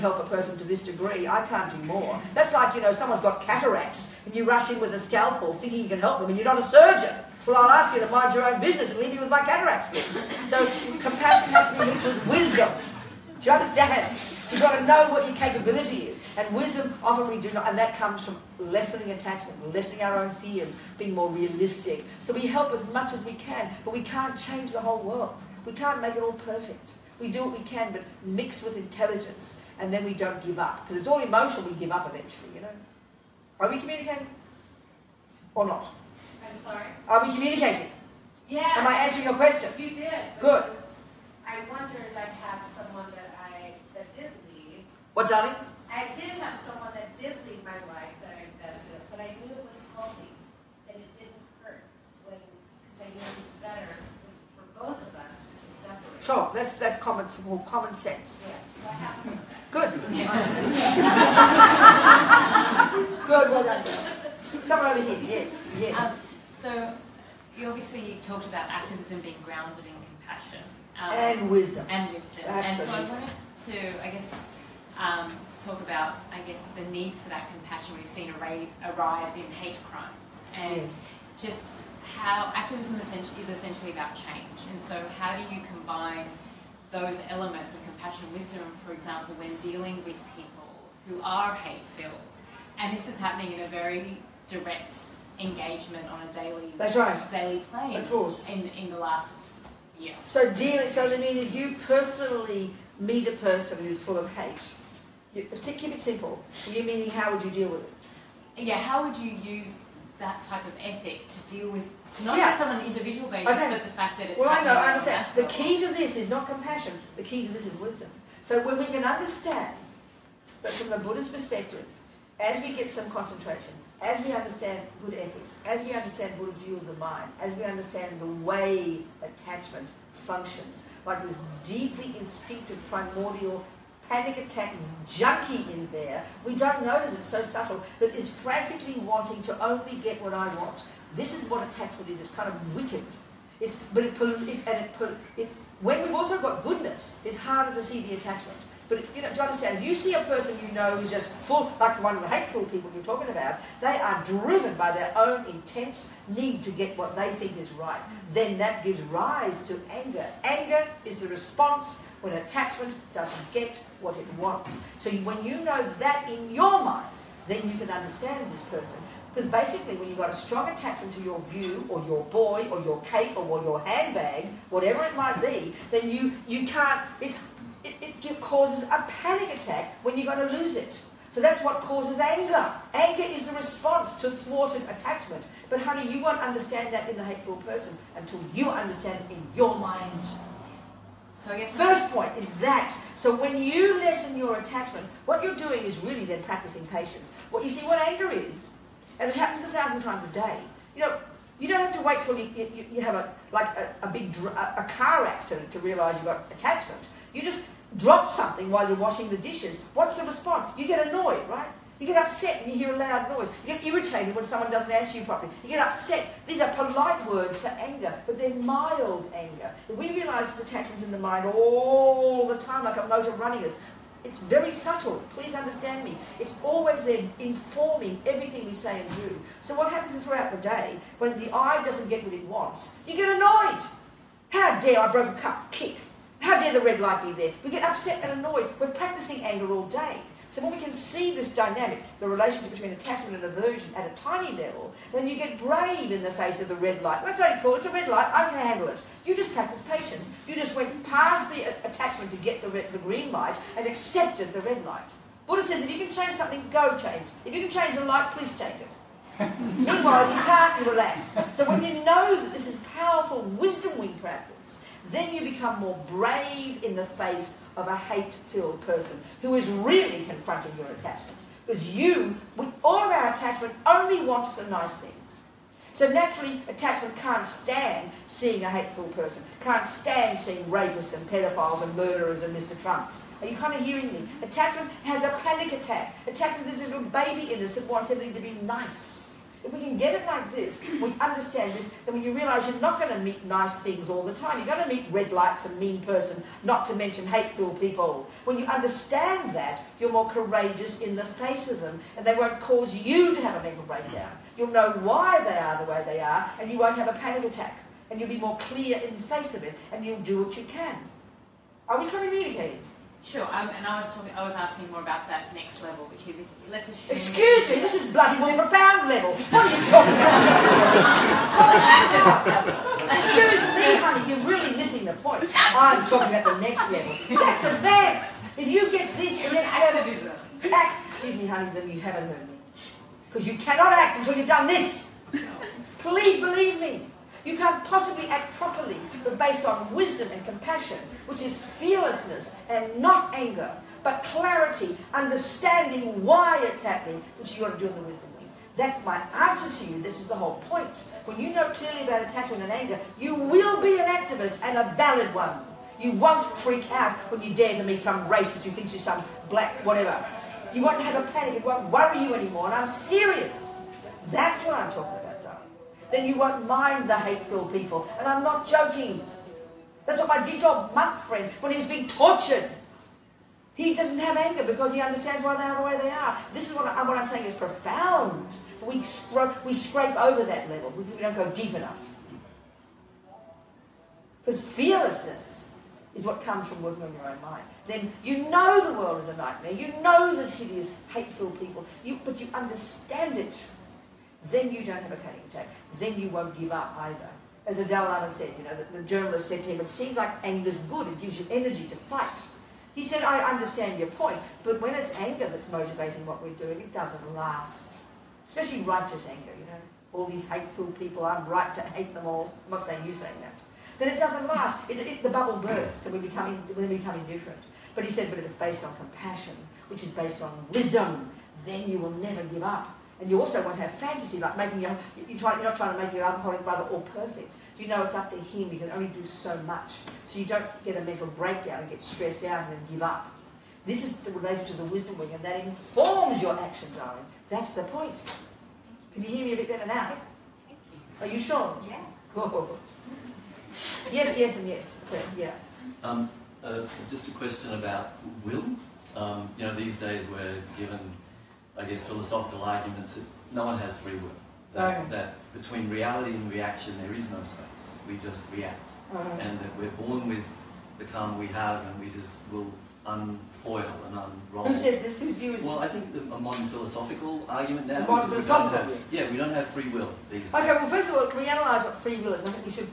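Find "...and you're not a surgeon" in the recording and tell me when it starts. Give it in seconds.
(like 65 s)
6 s.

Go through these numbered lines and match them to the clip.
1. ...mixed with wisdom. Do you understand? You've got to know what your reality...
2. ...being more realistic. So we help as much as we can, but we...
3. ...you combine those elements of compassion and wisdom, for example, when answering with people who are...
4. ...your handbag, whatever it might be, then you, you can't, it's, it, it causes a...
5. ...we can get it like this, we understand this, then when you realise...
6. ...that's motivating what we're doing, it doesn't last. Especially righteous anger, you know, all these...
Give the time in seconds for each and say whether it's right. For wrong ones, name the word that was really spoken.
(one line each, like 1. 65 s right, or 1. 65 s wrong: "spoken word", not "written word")
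1. 11 s wrong: "capability", not "reality"
2. 20 s right
3. 85 s wrong: "dealing", not "answering"
4. 173 s right
5. 289 s right
6. 405 s right.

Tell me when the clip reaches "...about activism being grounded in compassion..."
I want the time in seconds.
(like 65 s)
68 s.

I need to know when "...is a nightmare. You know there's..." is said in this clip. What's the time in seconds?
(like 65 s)
389 s.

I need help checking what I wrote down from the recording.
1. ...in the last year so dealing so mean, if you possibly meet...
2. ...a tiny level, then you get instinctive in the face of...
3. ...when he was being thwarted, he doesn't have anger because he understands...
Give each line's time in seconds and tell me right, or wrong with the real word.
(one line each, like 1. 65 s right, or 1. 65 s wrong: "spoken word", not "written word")
1. 98 s wrong: "personally", not "possibly"
2. 244 s wrong: "brave", not "instinctive"
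3. 371 s wrong: "tortured", not "thwarted".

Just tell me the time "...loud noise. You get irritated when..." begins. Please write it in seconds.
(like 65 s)
212 s.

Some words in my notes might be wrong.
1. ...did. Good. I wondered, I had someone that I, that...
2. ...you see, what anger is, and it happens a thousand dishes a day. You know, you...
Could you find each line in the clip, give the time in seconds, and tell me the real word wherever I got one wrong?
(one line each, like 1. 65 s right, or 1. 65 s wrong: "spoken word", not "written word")
1. 39 s right
2. 197 s wrong: "times", not "dishes".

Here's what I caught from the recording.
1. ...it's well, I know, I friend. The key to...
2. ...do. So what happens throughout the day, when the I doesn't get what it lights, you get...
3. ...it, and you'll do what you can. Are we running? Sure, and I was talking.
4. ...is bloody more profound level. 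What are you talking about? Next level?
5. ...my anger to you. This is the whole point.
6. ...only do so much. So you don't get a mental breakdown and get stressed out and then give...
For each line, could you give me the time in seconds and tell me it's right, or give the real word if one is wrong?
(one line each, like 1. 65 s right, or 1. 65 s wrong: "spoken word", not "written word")
1. 114 s wrong: "understand", not "friend"
2. 229 s wrong: "wants", not "lights"
3. 309 s wrong: "communicating", not "running"
4. 317 s right
5. 349 s wrong: "answer", not "anger"
6. 428 s right.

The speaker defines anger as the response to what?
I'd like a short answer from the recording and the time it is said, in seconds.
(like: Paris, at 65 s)
thwarted attachment, at 184 s.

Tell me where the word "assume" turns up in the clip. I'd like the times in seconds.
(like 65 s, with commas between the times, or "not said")
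316 s.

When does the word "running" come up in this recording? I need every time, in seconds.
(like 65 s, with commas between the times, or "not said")
223 s.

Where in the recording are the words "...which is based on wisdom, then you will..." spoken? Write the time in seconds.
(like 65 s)
419 s.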